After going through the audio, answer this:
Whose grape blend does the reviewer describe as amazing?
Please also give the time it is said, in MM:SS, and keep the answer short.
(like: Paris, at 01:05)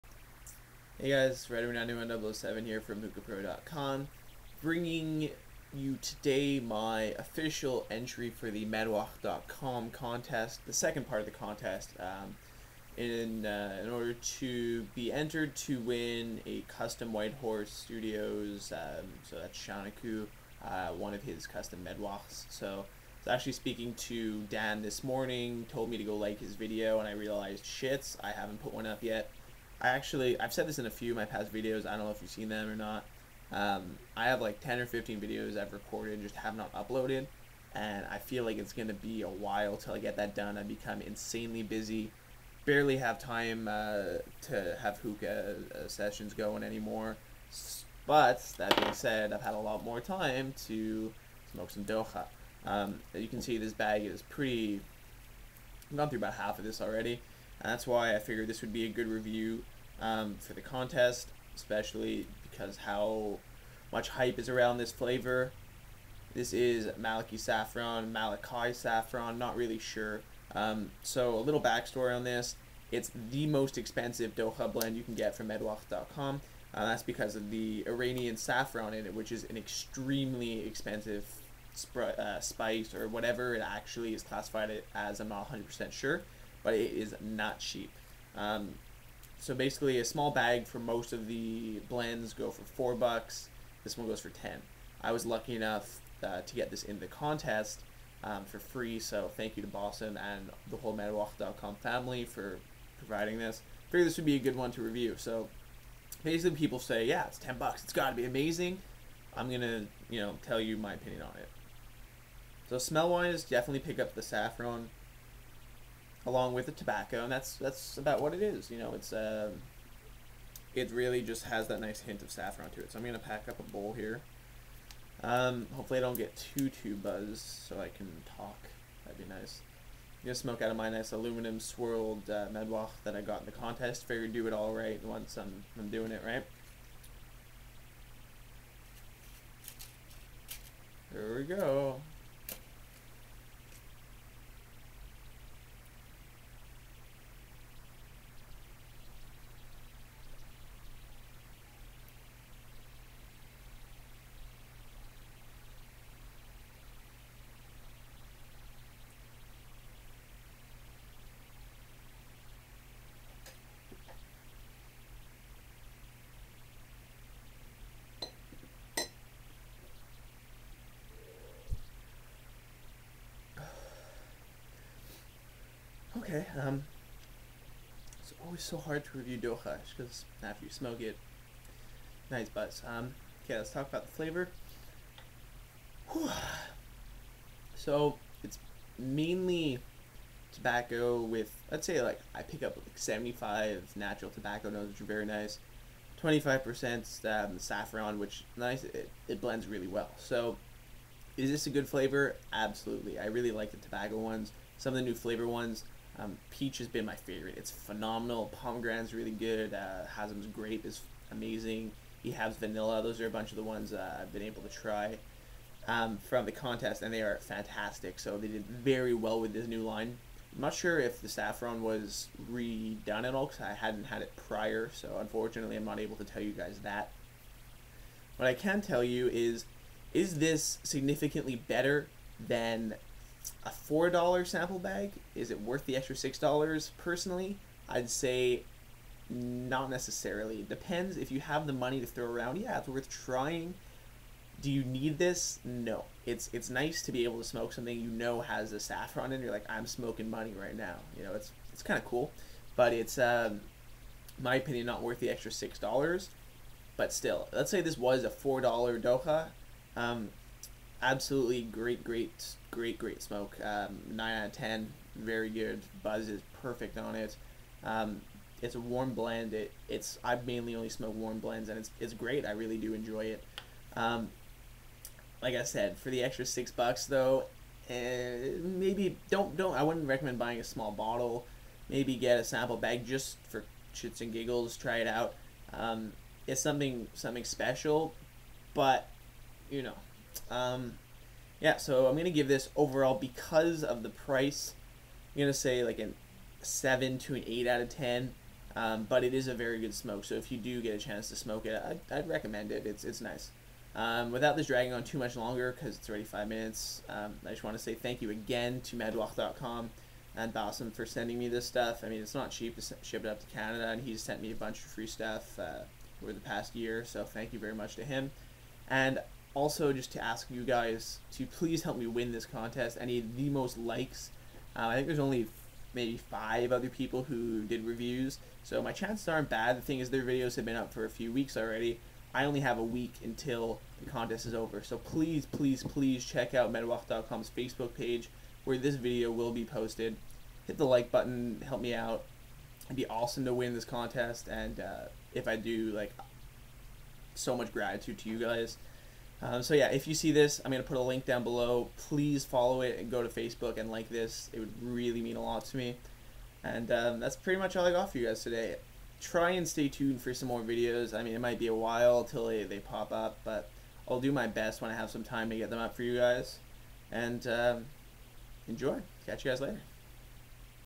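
Hazem, at 03:30.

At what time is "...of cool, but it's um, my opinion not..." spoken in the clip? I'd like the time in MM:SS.
04:11.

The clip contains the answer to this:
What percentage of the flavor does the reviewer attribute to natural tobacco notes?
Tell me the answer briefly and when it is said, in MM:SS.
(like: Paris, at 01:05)
75, at 03:12.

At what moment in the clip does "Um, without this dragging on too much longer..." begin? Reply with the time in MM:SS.
05:03.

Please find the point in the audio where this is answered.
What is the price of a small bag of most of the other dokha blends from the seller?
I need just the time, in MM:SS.
01:32.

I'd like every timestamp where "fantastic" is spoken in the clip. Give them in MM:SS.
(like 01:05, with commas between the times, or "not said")
03:37.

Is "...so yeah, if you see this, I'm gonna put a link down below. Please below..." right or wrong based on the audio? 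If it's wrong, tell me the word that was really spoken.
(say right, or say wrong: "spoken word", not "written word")
wrong: "follow", not "below".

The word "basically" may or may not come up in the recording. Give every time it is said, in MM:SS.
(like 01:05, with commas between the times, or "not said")
01:29, 01:46.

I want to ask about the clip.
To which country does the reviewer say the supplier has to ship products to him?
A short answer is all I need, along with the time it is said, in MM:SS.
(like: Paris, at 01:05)
Canada, at 05:13.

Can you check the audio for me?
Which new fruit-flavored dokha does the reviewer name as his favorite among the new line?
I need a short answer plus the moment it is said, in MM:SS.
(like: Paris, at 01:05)
Peach, at 03:26.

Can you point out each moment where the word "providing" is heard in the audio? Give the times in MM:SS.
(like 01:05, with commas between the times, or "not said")
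01:42.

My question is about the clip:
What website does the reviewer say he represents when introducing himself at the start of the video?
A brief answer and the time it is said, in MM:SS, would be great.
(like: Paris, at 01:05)
Mookapro.com, at 00:03.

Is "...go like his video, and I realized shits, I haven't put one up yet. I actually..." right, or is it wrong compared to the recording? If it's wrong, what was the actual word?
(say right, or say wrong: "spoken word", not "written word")
right.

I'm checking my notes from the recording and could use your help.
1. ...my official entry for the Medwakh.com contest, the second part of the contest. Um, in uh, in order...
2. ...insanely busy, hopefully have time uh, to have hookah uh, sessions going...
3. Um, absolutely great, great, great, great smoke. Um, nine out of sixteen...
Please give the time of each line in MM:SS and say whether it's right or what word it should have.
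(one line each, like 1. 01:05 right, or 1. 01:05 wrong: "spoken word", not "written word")
1. 00:06 right
2. 00:41 wrong: "barely", not "hopefully"
3. 04:19 wrong: "ten", not "sixteen".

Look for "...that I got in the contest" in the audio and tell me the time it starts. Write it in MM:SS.
02:13.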